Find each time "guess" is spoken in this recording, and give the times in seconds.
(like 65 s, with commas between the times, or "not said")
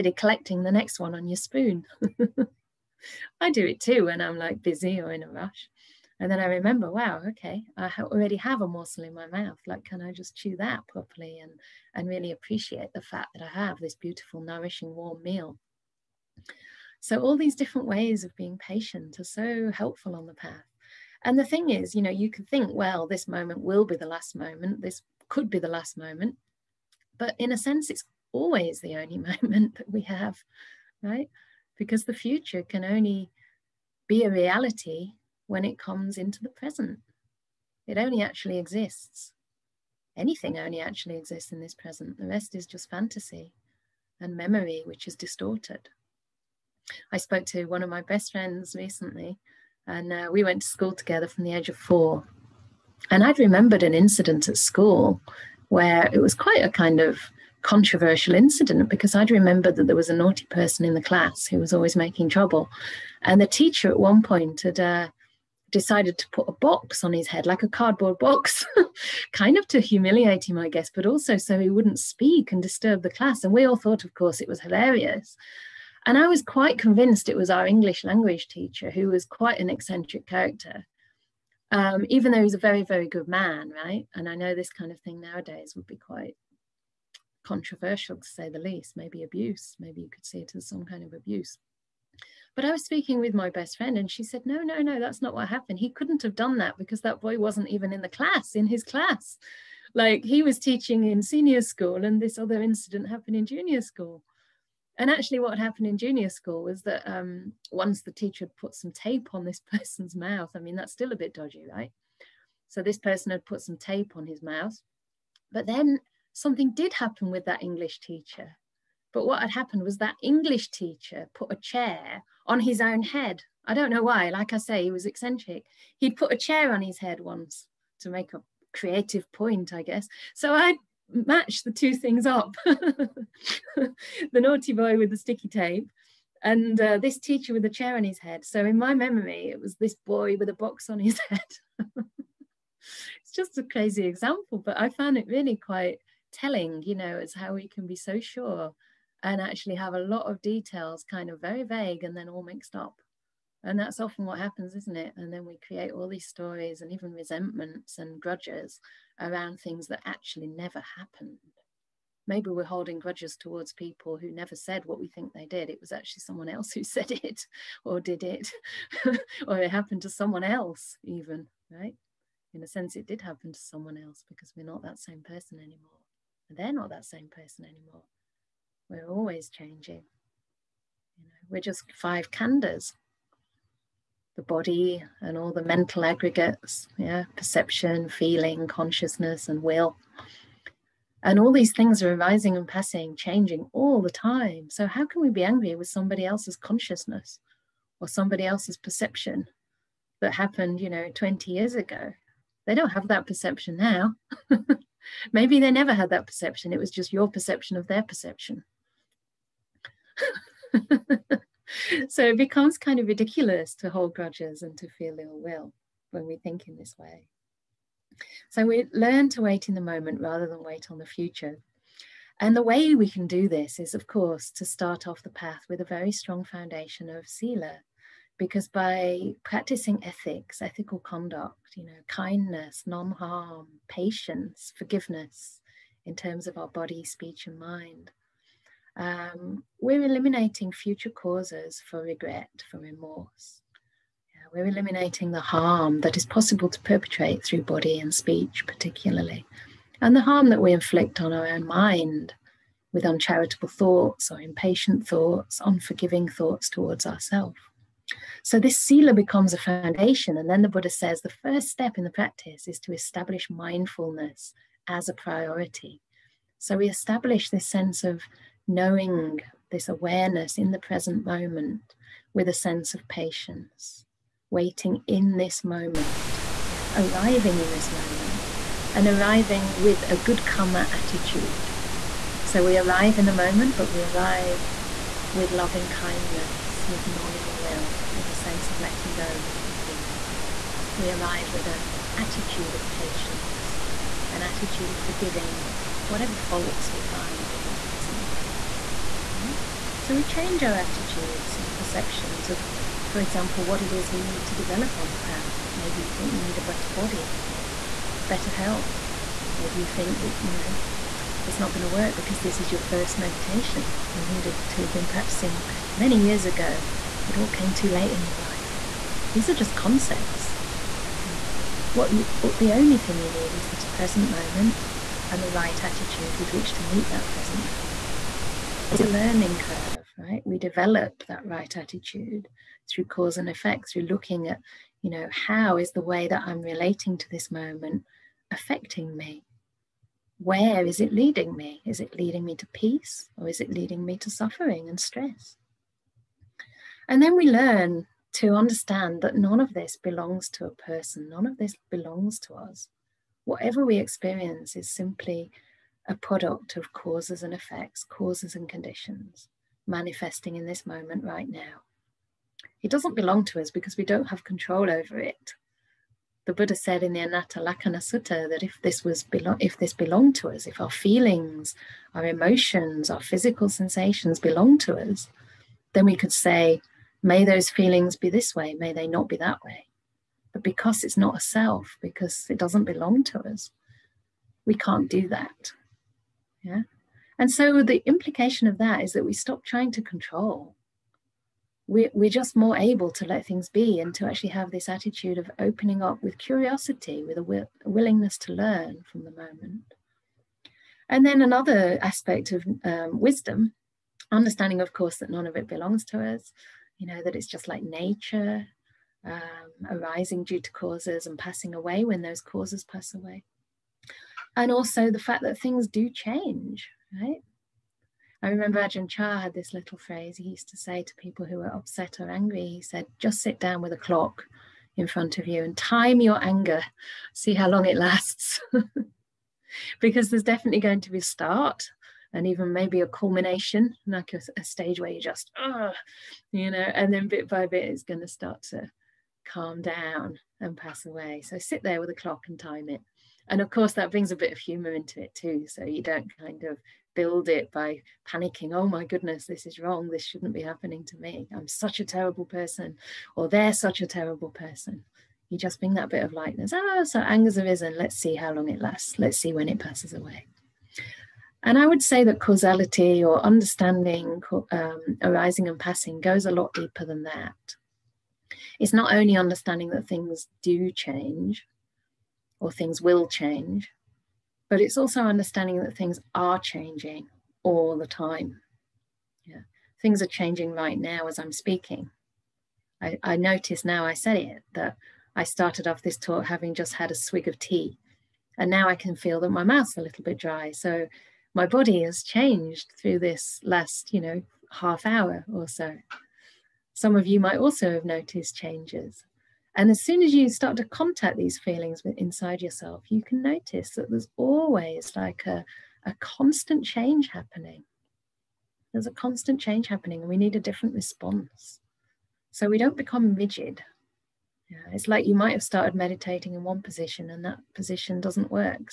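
70 s, 129 s.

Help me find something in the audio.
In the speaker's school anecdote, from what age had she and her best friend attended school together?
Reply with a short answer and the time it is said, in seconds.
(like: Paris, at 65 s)
4, at 51 s.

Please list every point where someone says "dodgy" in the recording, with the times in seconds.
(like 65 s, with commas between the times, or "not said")
111 s.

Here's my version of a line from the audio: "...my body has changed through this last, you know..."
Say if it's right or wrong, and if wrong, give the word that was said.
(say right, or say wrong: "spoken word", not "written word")
right.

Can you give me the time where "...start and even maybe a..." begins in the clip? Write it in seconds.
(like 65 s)
431 s.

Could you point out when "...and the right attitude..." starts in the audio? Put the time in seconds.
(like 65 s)
325 s.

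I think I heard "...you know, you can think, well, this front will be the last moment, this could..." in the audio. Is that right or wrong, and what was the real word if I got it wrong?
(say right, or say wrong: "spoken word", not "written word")
wrong: "moment", not "front".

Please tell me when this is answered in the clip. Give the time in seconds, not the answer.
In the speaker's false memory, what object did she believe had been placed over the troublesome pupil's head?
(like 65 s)
67 s.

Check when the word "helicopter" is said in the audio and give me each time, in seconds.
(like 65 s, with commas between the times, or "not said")
not said.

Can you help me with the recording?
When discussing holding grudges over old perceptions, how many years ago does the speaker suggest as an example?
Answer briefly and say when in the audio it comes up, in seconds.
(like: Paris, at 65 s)
20, at 201 s.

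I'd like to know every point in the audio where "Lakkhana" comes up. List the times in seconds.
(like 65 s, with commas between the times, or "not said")
367 s.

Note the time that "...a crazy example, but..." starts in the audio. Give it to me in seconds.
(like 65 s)
143 s.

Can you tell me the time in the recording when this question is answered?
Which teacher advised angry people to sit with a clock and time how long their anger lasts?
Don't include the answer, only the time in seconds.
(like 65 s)
418 s.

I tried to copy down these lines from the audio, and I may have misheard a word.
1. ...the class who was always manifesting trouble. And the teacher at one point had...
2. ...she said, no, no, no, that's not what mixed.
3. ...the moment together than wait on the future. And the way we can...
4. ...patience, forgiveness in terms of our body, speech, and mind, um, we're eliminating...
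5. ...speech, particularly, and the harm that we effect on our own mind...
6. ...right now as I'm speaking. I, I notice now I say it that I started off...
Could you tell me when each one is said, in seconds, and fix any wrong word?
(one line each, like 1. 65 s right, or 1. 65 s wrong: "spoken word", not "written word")
1. 60 s wrong: "making", not "manifesting"
2. 94 s wrong: "happened", not "mixed"
3. 219 s wrong: "rather", not "together"
4. 233 s right
5. 248 s wrong: "inflict", not "effect"
6. 480 s right.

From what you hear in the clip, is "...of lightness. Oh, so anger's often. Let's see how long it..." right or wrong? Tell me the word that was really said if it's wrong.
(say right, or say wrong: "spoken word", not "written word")
wrong: "arisen", not "often".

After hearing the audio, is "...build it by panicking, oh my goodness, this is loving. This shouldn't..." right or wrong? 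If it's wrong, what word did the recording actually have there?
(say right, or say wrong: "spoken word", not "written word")
wrong: "wrong", not "loving".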